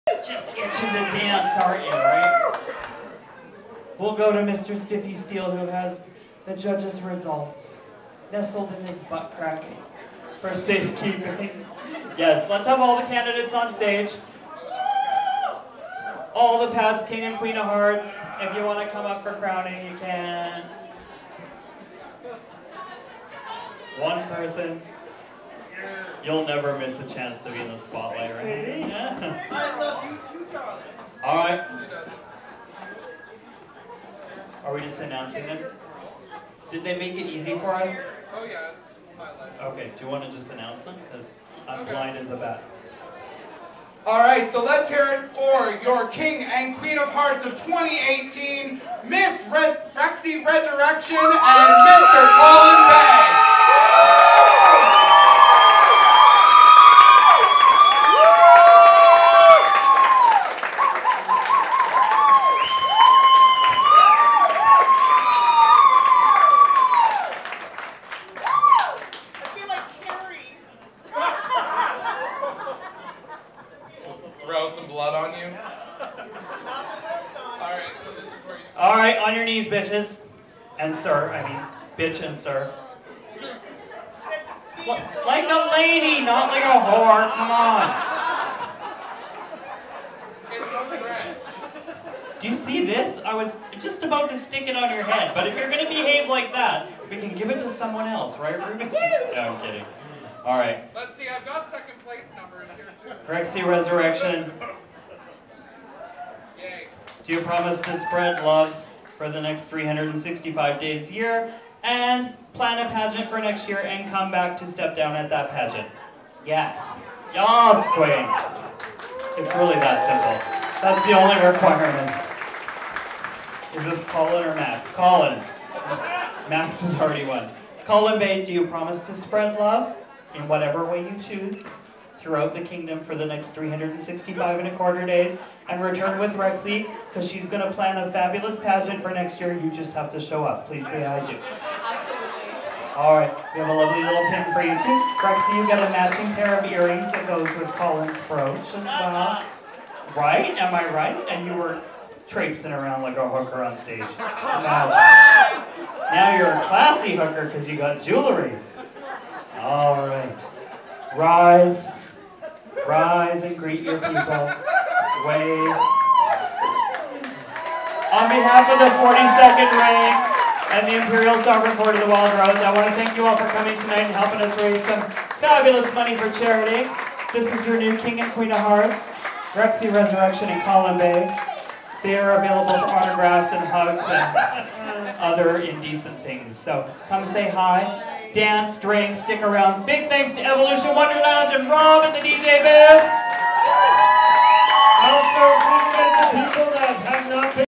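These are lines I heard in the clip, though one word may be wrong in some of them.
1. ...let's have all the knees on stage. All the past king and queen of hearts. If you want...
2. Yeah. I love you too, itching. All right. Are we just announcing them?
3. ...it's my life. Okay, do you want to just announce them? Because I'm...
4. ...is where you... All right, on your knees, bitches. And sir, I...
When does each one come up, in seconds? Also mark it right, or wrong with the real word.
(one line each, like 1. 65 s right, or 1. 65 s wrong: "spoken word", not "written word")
1. 12 s wrong: "candidates", not "knees"
2. 28 s wrong: "darling", not "itching"
3. 38 s right
4. 78 s right.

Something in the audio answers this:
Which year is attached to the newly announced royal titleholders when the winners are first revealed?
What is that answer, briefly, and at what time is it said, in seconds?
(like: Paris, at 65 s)
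2018, at 47 s.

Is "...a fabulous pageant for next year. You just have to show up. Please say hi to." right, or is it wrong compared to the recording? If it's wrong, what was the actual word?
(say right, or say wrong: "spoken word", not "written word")
right.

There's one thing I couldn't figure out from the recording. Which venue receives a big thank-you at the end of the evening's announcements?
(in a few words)
Evolution Wonder Lounge.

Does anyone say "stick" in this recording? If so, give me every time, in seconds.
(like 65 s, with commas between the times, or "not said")
94 s, 189 s.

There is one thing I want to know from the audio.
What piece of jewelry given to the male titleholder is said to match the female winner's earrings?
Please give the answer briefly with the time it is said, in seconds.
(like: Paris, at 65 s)
brooch, at 148 s.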